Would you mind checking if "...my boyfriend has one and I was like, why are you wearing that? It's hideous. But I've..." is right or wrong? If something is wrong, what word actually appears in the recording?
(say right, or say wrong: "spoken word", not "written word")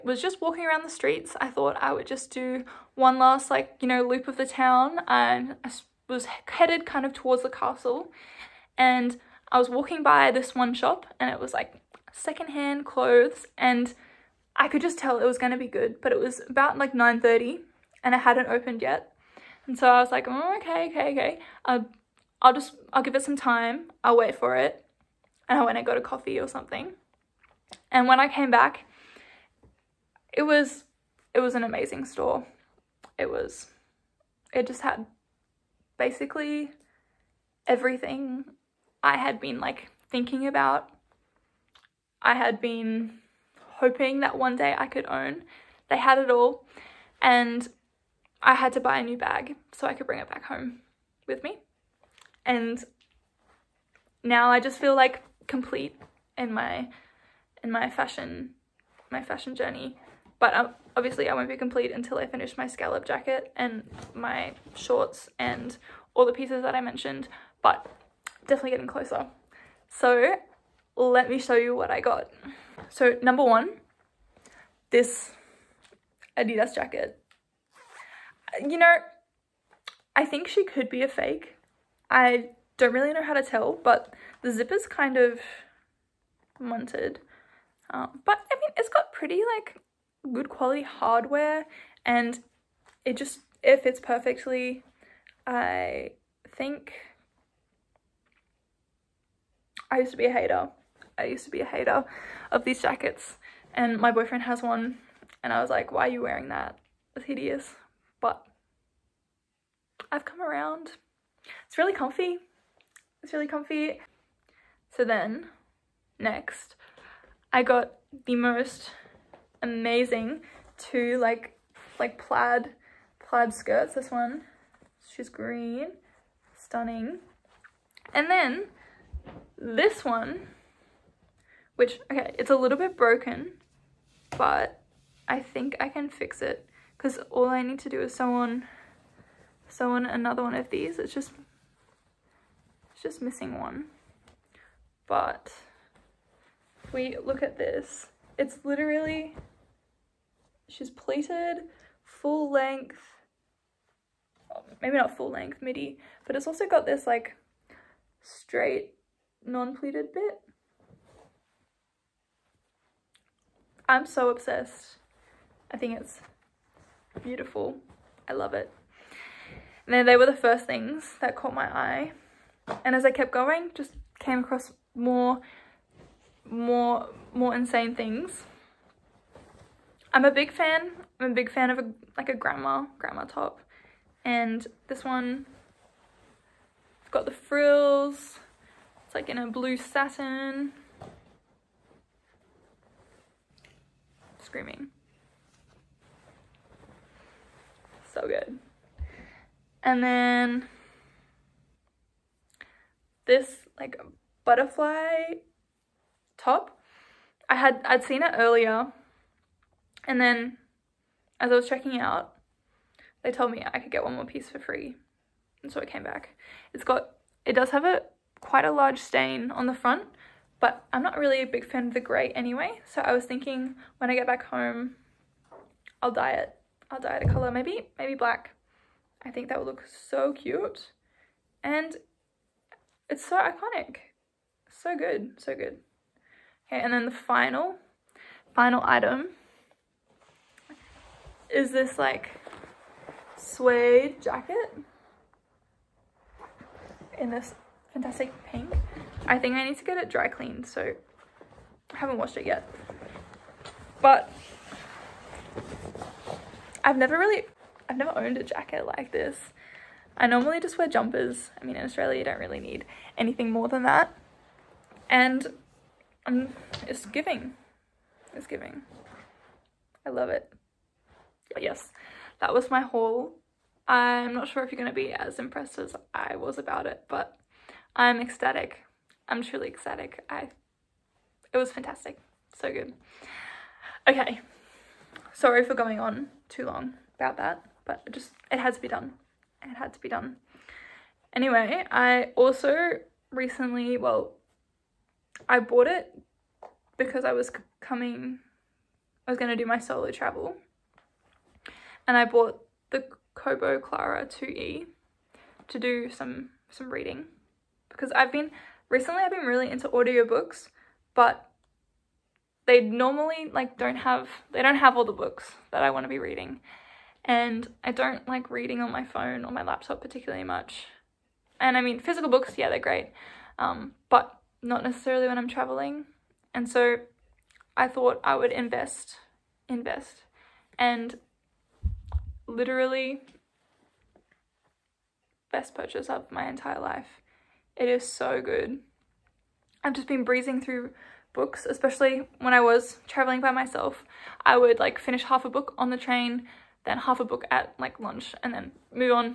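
right.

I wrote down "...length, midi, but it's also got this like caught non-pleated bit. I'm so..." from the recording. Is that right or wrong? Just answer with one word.
wrong.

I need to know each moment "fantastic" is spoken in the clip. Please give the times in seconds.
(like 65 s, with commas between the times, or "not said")
247 s, 281 s.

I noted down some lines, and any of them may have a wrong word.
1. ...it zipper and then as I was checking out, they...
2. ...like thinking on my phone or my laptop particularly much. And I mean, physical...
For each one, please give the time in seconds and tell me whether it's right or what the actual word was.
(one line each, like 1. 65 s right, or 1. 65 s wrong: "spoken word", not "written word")
1. 208 s wrong: "earlier", not "zipper"
2. 318 s wrong: "reading", not "thinking".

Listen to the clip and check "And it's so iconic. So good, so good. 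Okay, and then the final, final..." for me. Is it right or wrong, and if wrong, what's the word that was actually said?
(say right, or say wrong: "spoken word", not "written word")
right.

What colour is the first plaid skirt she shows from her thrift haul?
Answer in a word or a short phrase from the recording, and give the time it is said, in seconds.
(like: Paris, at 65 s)
Green, at 125 s.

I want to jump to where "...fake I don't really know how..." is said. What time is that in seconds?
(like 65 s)
81 s.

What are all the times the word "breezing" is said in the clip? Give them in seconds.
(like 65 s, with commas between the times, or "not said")
340 s.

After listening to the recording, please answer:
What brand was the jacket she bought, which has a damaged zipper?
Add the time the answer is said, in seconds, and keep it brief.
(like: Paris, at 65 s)
Adidas, at 76 s.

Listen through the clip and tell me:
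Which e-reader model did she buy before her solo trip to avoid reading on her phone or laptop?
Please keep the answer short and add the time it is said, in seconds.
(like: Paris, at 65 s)
Kobo Clara 2E, at 303 s.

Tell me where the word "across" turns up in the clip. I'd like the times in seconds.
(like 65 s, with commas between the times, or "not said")
174 s.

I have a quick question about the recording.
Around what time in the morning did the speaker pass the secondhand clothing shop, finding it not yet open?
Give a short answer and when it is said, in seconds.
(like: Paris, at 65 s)
9.30, at 16 s.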